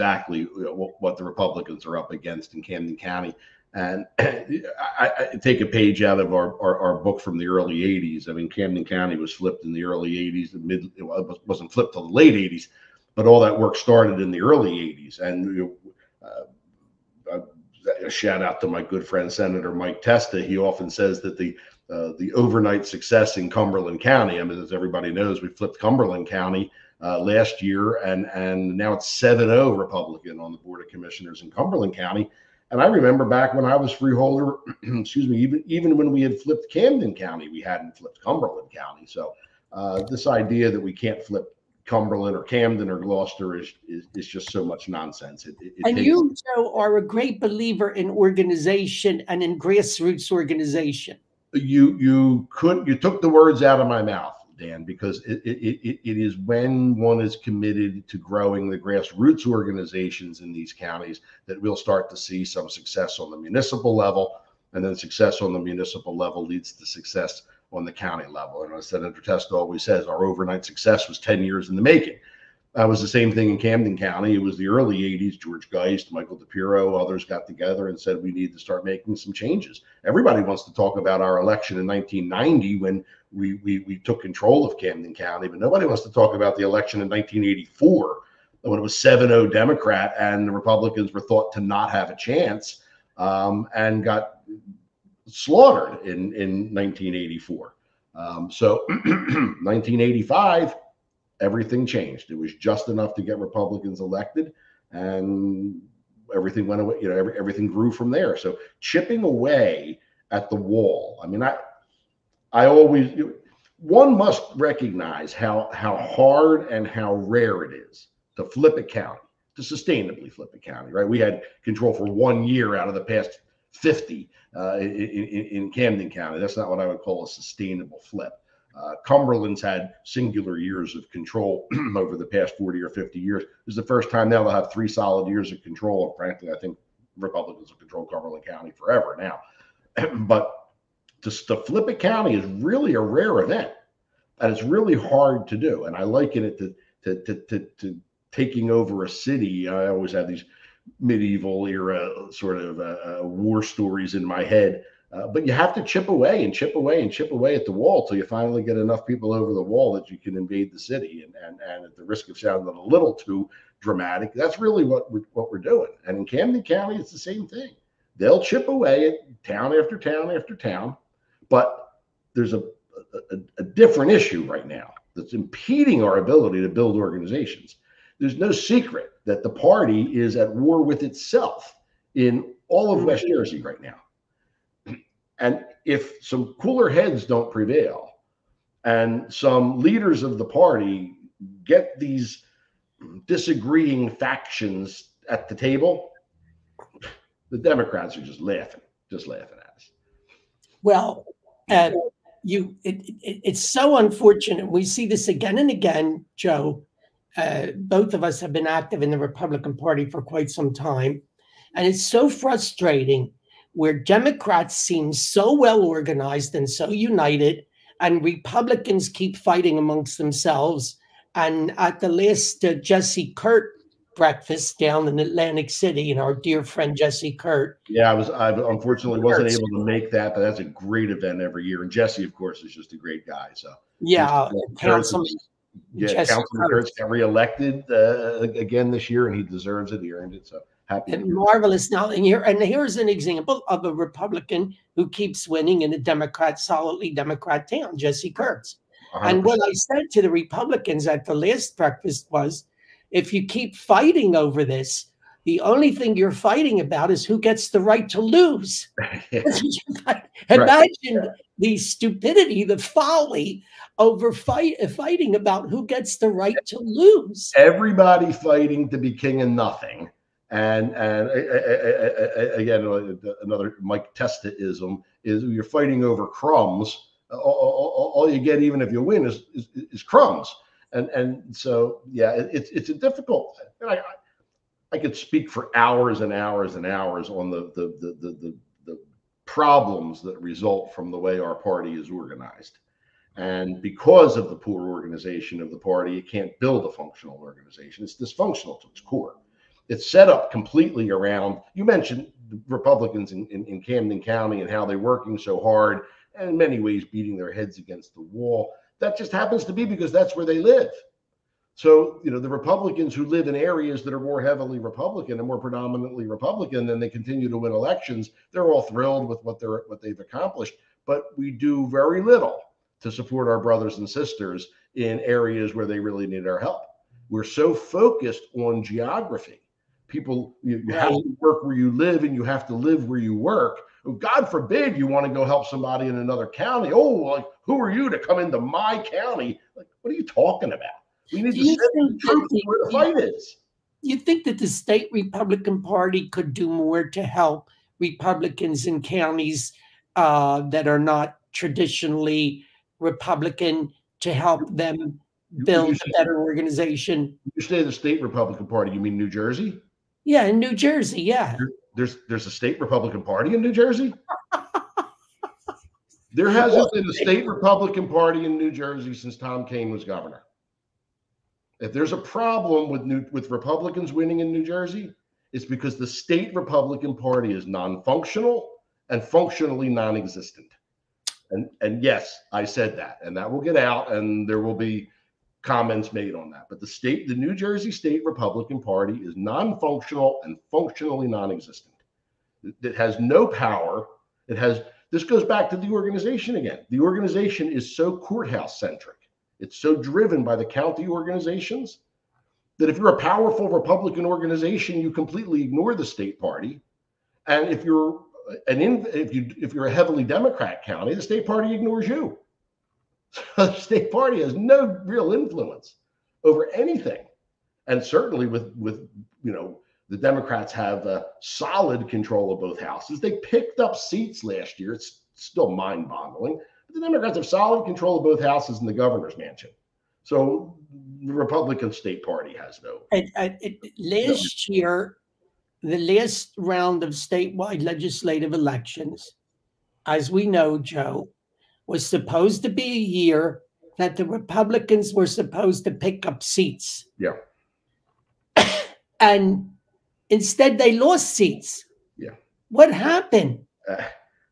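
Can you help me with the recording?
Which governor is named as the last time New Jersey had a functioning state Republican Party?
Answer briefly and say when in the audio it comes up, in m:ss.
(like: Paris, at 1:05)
Tom Kean, at 6:09.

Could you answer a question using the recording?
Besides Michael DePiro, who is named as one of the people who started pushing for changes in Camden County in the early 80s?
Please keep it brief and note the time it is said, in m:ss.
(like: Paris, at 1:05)
George Geist, at 1:15.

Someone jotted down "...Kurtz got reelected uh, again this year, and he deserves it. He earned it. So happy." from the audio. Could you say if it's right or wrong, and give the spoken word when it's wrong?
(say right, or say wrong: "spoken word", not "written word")
right.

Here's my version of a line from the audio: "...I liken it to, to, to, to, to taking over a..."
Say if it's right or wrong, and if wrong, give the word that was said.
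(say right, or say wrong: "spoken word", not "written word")
right.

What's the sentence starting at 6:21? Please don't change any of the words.
And and yes, I said that, and that will get out, and there will be comments made on that.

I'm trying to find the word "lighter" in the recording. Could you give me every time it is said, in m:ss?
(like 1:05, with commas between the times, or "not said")
not said.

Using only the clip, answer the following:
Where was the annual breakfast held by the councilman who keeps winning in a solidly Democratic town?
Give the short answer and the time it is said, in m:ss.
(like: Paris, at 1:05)
Atlantic City, at 3:45.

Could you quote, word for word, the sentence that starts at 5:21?
But we do very little to support our brothers and sisters in areas where they really need our help.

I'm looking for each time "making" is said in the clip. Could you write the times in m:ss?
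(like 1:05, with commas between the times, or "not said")
1:11, 1:18.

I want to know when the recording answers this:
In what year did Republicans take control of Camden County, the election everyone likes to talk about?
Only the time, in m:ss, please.
1:21.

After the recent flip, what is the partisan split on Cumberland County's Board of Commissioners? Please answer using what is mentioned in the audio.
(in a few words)
7-0 Republican.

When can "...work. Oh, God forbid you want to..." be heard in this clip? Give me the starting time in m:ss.
5:33.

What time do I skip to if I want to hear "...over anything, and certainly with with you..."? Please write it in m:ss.
6:56.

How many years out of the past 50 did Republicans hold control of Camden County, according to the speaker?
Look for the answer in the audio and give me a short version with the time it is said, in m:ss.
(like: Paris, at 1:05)
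one year, at 2:02.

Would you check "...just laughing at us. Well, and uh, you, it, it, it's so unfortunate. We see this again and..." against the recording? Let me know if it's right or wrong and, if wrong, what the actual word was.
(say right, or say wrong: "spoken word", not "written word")
right.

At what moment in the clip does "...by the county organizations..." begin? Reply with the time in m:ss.
6:40.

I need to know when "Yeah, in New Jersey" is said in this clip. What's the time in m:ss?
6:00.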